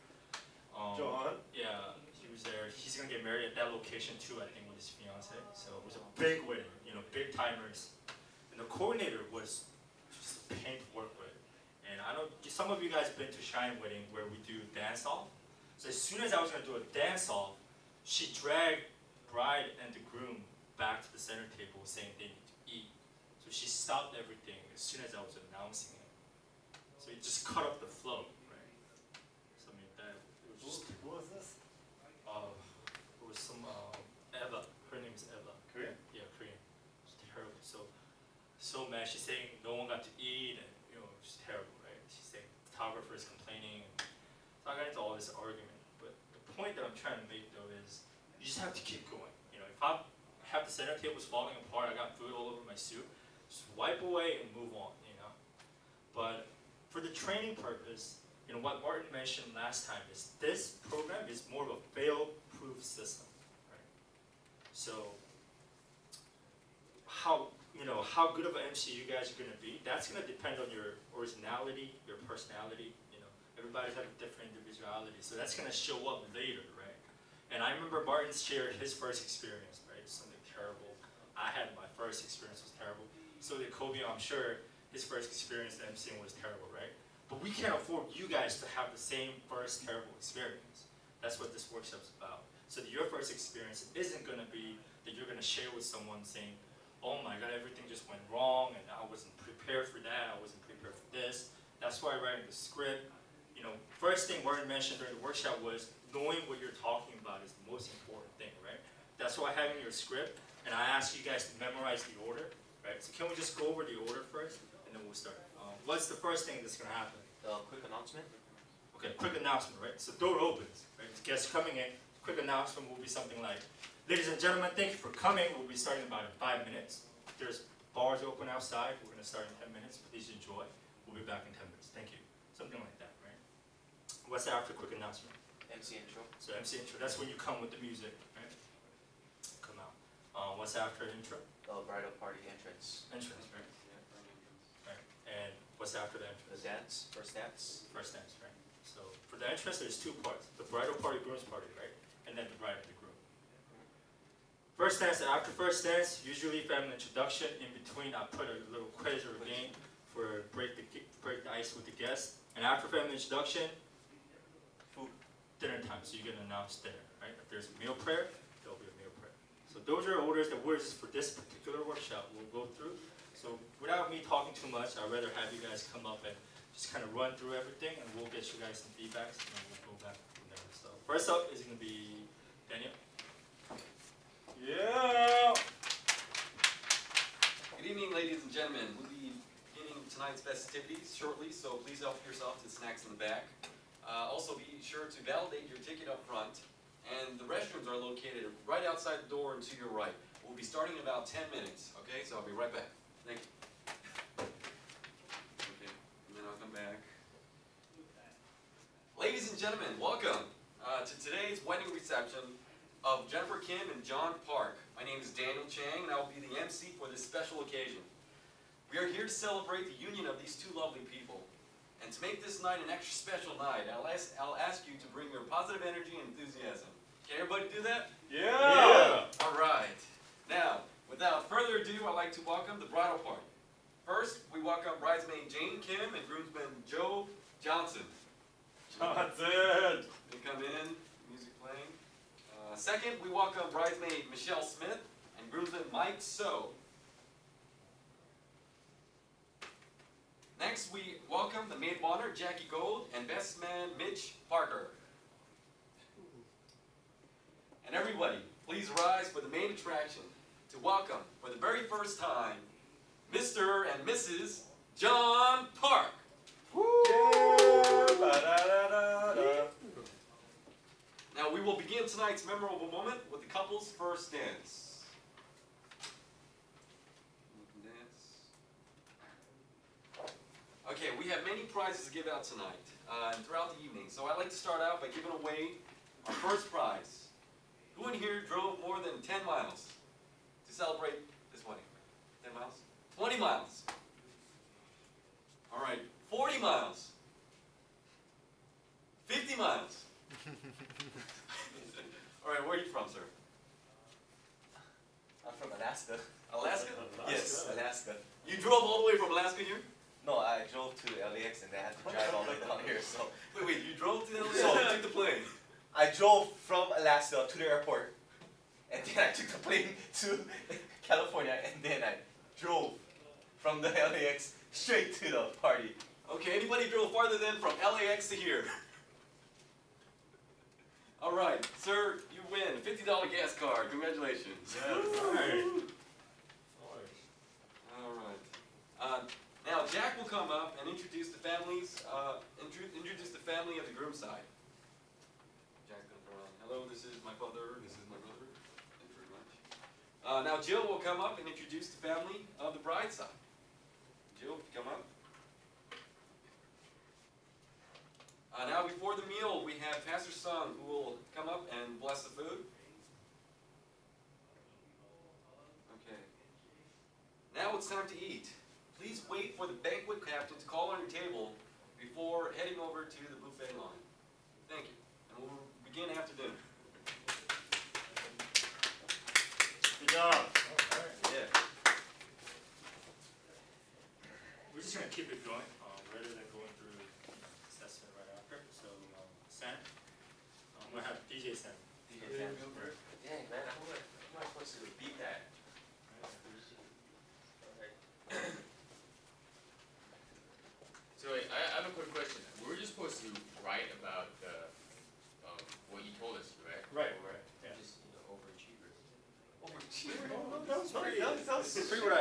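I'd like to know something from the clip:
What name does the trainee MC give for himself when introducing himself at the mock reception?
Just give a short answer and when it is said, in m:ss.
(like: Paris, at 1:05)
Daniel Chang, at 3:35.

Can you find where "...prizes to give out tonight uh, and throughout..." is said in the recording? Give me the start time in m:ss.
4:41.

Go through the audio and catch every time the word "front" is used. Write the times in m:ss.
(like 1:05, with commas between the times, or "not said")
3:16.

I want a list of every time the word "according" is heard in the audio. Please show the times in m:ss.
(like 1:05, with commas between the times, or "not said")
not said.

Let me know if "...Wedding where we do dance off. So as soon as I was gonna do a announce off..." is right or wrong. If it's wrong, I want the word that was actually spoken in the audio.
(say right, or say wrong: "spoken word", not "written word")
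wrong: "dance", not "announce".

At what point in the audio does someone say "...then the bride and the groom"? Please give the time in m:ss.
2:32.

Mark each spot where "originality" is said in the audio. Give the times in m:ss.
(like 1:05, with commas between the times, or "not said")
1:11.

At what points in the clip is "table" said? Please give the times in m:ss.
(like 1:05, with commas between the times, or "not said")
0:21, 0:50, 6:11.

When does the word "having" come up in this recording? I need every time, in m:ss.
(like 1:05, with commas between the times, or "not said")
1:49.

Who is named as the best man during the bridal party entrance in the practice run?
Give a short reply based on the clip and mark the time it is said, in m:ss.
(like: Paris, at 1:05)
Mitch Parker, at 4:13.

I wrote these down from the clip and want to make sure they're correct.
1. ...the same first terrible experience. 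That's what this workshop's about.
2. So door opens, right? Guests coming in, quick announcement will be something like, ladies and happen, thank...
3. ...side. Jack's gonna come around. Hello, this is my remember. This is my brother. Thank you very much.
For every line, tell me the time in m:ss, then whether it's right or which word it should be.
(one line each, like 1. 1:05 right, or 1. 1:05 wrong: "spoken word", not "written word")
1. 1:28 right
2. 2:00 wrong: "gentlemen", not "happen"
3. 5:44 wrong: "father", not "remember".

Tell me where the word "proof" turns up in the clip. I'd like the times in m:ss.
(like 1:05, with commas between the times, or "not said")
1:01.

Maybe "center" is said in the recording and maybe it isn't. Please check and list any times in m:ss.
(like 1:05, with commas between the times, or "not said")
0:21, 0:50.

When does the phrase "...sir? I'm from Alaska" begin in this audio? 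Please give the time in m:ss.
5:03.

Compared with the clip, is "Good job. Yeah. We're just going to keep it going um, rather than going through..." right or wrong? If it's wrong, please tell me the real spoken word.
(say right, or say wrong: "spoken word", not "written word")
right.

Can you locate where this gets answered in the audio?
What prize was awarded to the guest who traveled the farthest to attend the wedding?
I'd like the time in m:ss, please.
5:32.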